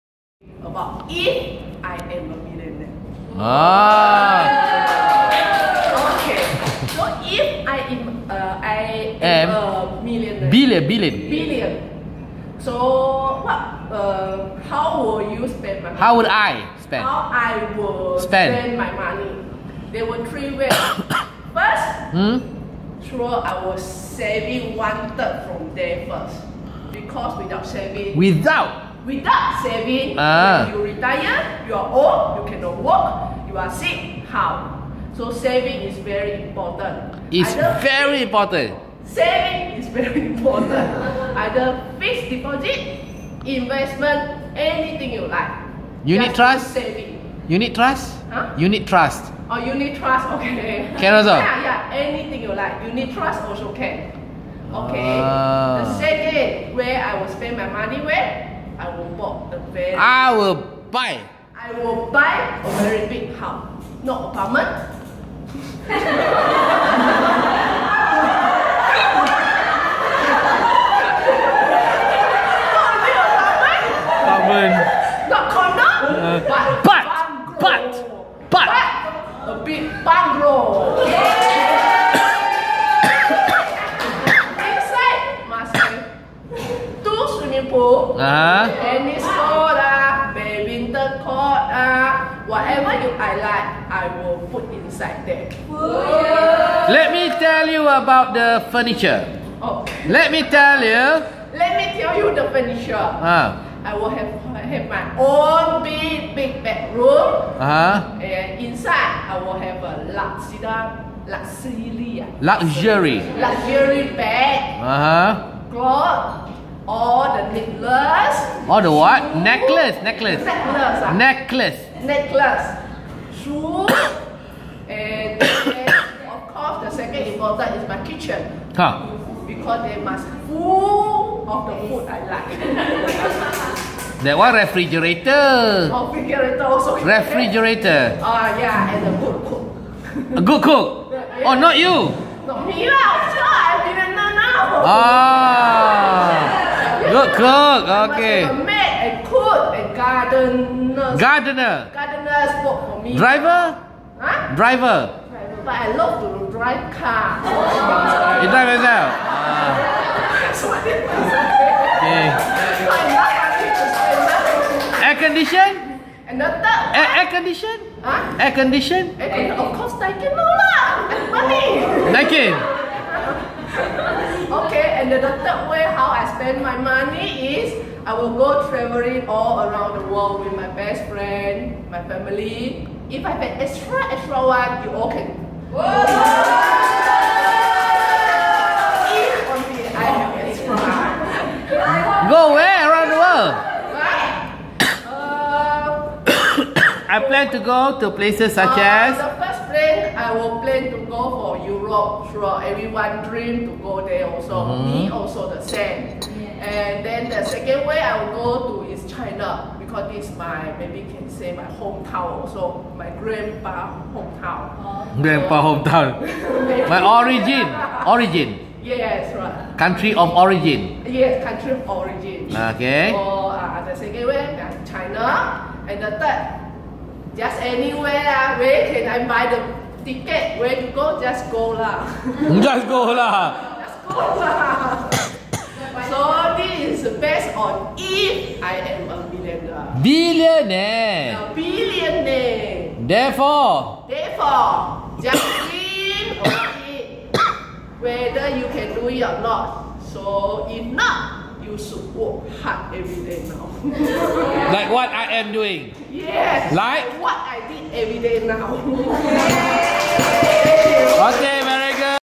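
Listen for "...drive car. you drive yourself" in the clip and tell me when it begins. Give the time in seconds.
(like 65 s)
156 s.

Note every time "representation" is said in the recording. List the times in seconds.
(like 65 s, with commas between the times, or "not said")
not said.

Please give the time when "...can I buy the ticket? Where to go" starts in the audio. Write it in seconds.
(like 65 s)
228 s.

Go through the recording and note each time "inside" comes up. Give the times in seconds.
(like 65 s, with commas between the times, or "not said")
94 s, 108 s.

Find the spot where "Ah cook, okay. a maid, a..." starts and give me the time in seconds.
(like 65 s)
144 s.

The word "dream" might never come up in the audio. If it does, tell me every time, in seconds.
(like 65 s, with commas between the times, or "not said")
203 s, 245 s.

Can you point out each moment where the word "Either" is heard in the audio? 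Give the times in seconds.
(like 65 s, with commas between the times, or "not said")
41 s.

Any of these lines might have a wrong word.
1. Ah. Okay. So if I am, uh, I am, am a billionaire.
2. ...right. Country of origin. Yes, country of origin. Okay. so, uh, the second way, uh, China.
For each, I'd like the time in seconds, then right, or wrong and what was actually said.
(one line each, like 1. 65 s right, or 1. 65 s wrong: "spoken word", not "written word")
1. 3 s wrong: "millionaire", not "billionaire"
2. 219 s right.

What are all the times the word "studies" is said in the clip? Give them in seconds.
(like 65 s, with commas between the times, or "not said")
not said.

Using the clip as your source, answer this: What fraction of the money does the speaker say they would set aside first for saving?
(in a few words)
one third.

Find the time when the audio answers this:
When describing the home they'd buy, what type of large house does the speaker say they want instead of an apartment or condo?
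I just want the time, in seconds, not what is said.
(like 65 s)
79 s.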